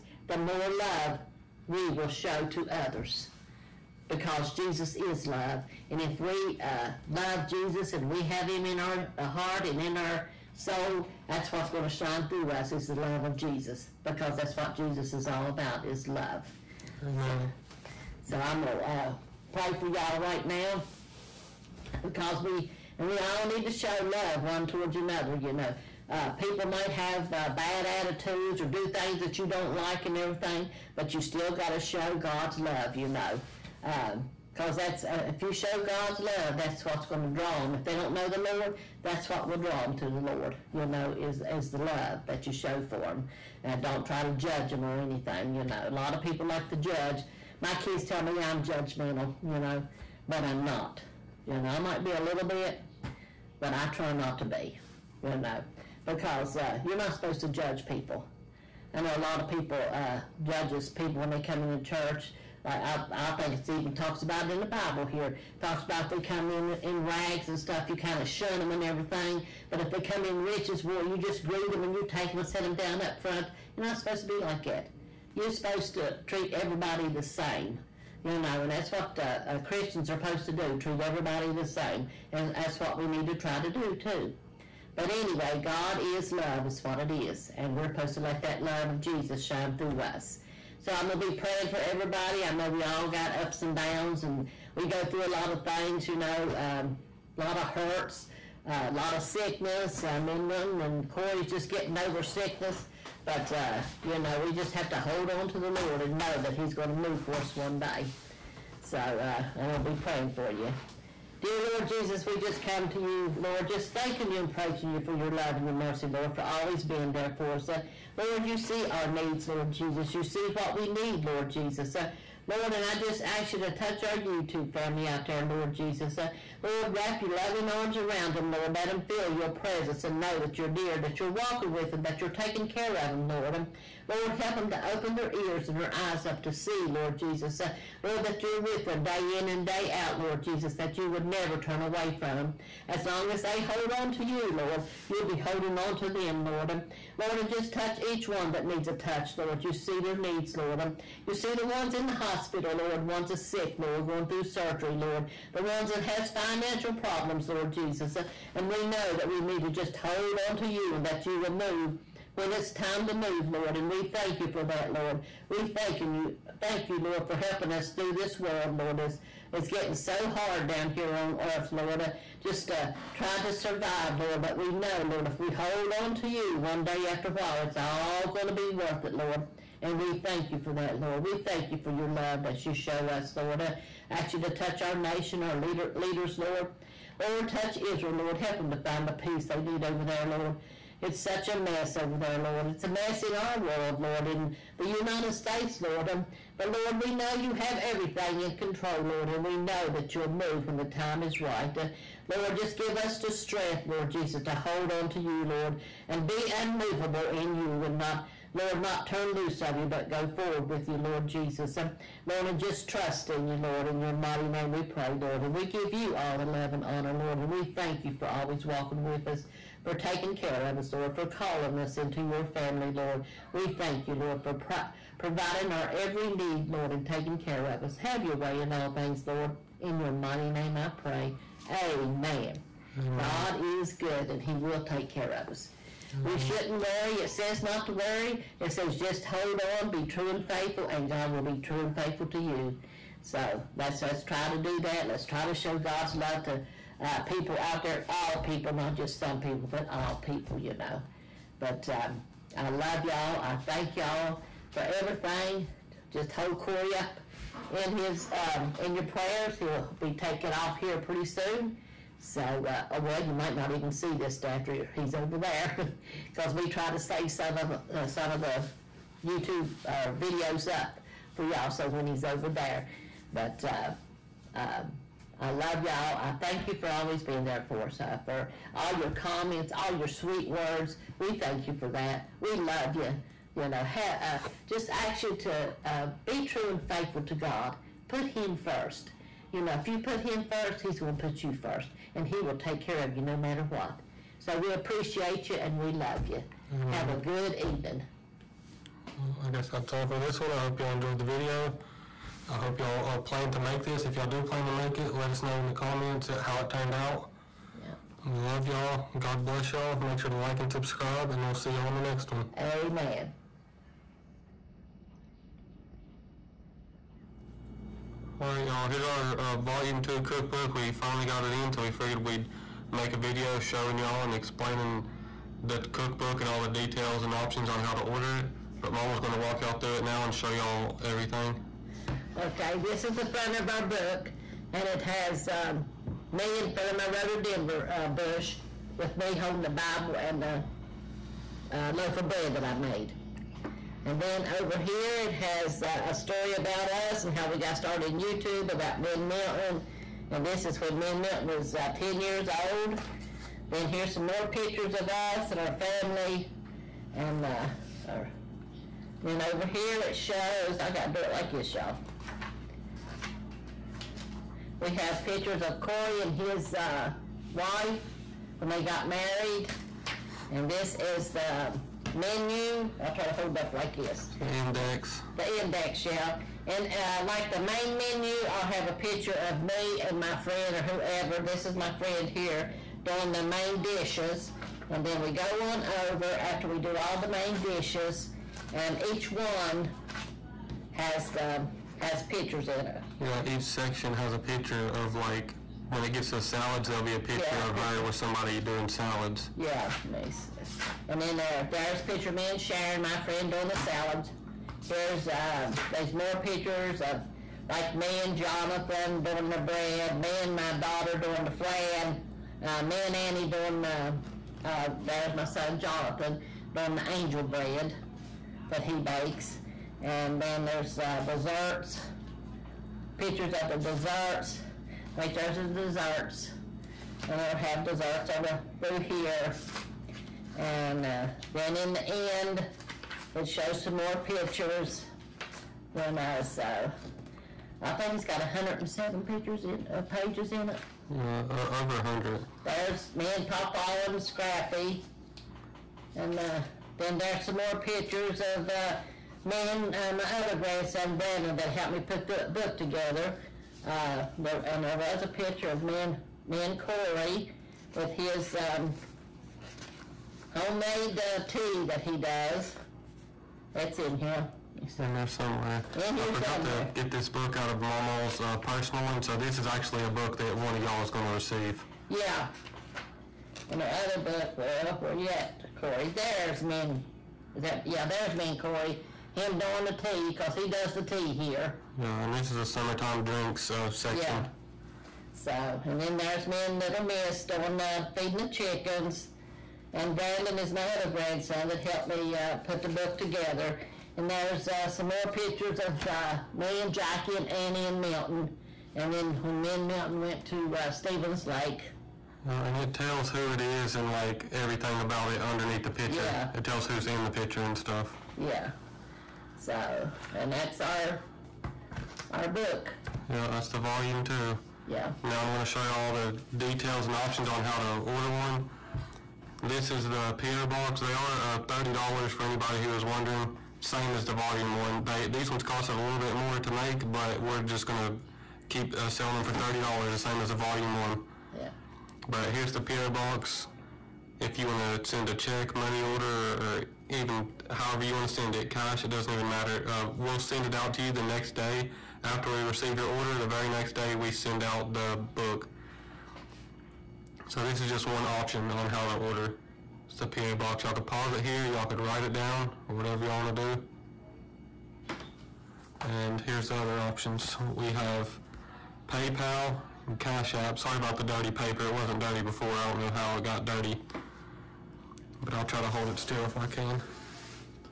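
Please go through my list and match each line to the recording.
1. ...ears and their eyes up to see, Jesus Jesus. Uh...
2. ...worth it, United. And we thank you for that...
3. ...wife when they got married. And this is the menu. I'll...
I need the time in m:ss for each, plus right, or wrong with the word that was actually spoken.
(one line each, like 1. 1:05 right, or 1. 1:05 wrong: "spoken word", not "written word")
1. 2:15 wrong: "Lord", not "Jesus"
2. 2:58 wrong: "Lord", not "United"
3. 6:07 right.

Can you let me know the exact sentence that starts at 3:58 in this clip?
It says just hold on, be true and faithful, and God will be true and faithful to you.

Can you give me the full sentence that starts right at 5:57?
And uh, our, then over here, it shows, I gotta do it like this, y'all.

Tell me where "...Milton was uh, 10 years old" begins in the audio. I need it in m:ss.
5:51.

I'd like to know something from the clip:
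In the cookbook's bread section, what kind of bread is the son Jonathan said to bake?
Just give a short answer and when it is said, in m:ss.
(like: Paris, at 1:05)
Angel bread, at 6:57.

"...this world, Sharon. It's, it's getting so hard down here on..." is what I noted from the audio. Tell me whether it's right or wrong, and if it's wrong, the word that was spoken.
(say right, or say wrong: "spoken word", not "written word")
wrong: "Lord", not "Sharon".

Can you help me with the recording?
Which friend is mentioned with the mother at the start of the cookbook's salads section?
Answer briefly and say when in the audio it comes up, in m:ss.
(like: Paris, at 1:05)
Sharon, at 6:42.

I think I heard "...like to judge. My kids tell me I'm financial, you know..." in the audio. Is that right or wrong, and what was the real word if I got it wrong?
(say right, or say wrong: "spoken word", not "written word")
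wrong: "judgmental", not "financial".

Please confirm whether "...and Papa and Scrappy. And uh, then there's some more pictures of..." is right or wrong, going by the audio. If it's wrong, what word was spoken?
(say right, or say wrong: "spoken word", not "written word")
right.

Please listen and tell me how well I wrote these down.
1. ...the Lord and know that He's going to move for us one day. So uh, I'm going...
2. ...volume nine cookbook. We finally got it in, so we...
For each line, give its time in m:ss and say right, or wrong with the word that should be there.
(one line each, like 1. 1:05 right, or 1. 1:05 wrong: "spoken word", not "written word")
1. 1:45 right
2. 5:19 wrong: "two", not "nine".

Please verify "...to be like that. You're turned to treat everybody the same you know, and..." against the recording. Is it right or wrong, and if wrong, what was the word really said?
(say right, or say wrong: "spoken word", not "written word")
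wrong: "supposed", not "turned".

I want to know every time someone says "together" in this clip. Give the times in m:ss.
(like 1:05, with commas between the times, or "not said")
7:32, 8:13.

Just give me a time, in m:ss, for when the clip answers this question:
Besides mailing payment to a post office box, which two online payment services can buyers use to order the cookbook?
9:19.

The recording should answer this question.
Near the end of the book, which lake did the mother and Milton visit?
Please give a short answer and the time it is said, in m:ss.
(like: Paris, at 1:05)
Stevens Lake, at 8:20.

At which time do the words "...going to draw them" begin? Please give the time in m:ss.
0:37.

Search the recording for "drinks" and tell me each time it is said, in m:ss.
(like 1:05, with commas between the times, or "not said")
8:03.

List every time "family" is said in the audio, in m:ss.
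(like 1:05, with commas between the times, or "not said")
2:04, 3:42, 5:55.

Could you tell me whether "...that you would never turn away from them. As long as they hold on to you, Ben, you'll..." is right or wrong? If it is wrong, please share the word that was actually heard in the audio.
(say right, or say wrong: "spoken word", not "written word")
wrong: "Lord", not "Ben".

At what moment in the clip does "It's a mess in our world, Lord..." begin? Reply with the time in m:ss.
3:12.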